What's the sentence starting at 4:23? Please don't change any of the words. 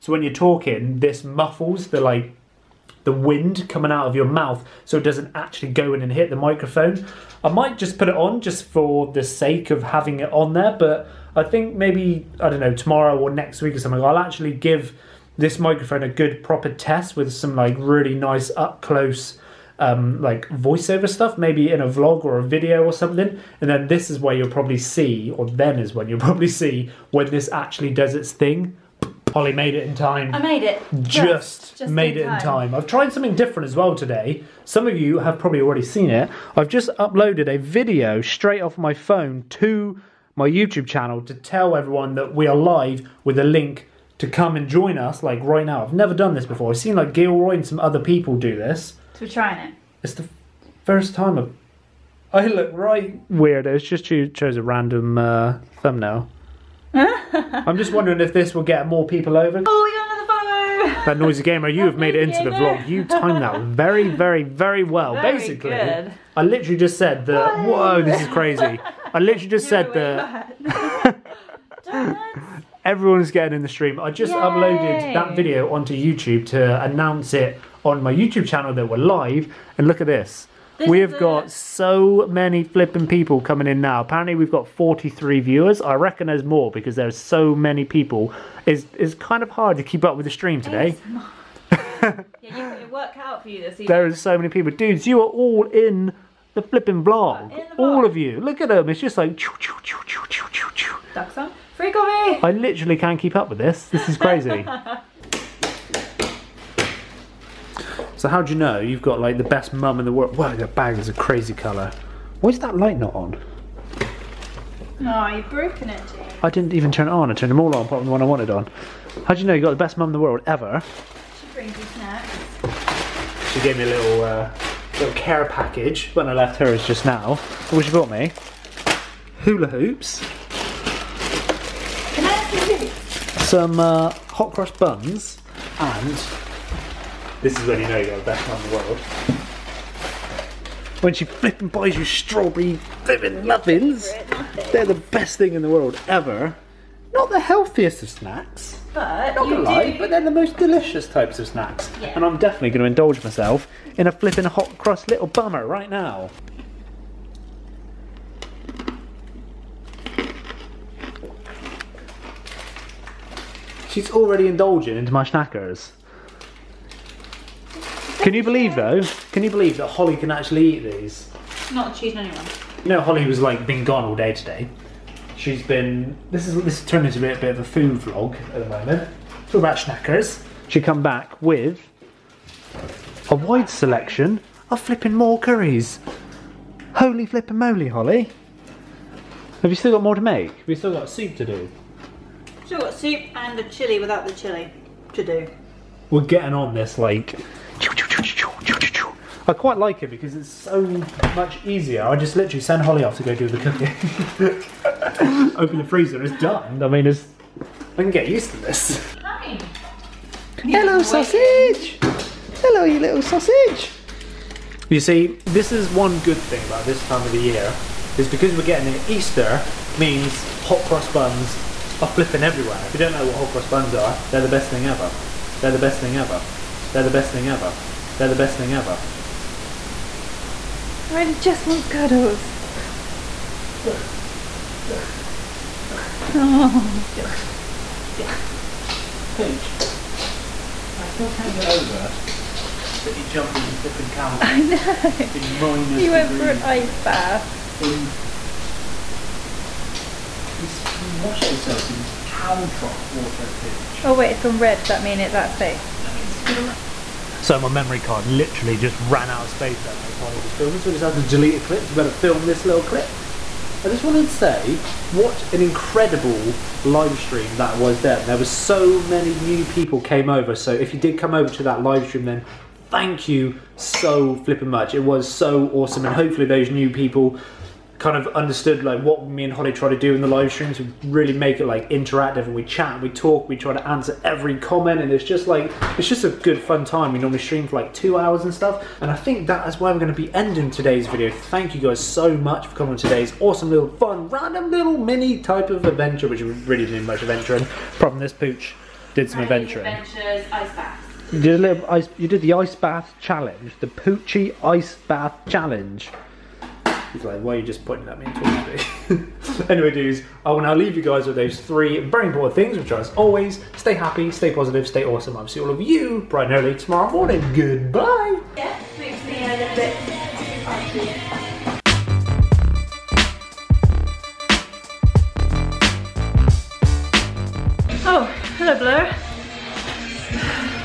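I just wanted to say, what an incredible live stream that was then.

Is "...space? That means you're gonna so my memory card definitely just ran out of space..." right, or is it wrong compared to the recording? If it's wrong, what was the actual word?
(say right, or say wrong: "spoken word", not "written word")
wrong: "literally", not "definitely".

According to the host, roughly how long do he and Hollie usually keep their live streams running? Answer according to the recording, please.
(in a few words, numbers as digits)
2 hours.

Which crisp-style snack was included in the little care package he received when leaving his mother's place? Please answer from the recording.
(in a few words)
Hula Hoops.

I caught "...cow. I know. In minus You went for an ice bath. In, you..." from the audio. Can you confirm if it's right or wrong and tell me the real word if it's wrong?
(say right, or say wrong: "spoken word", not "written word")
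right.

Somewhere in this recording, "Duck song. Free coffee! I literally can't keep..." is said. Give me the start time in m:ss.
1:41.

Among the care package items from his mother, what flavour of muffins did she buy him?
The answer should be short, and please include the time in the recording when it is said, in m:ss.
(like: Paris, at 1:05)
Strawberry, at 2:22.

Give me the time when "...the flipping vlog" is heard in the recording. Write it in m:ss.
1:36.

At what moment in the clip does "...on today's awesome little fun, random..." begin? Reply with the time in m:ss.
4:52.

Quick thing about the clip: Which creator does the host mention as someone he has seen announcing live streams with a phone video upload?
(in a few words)
Gilroy.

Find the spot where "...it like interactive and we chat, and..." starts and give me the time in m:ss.
4:41.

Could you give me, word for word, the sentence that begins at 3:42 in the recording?
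If you don't know what hot cross buns are, they're the best thing ever.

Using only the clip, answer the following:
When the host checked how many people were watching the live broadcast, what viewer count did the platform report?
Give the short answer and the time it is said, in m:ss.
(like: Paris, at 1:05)
43, at 1:24.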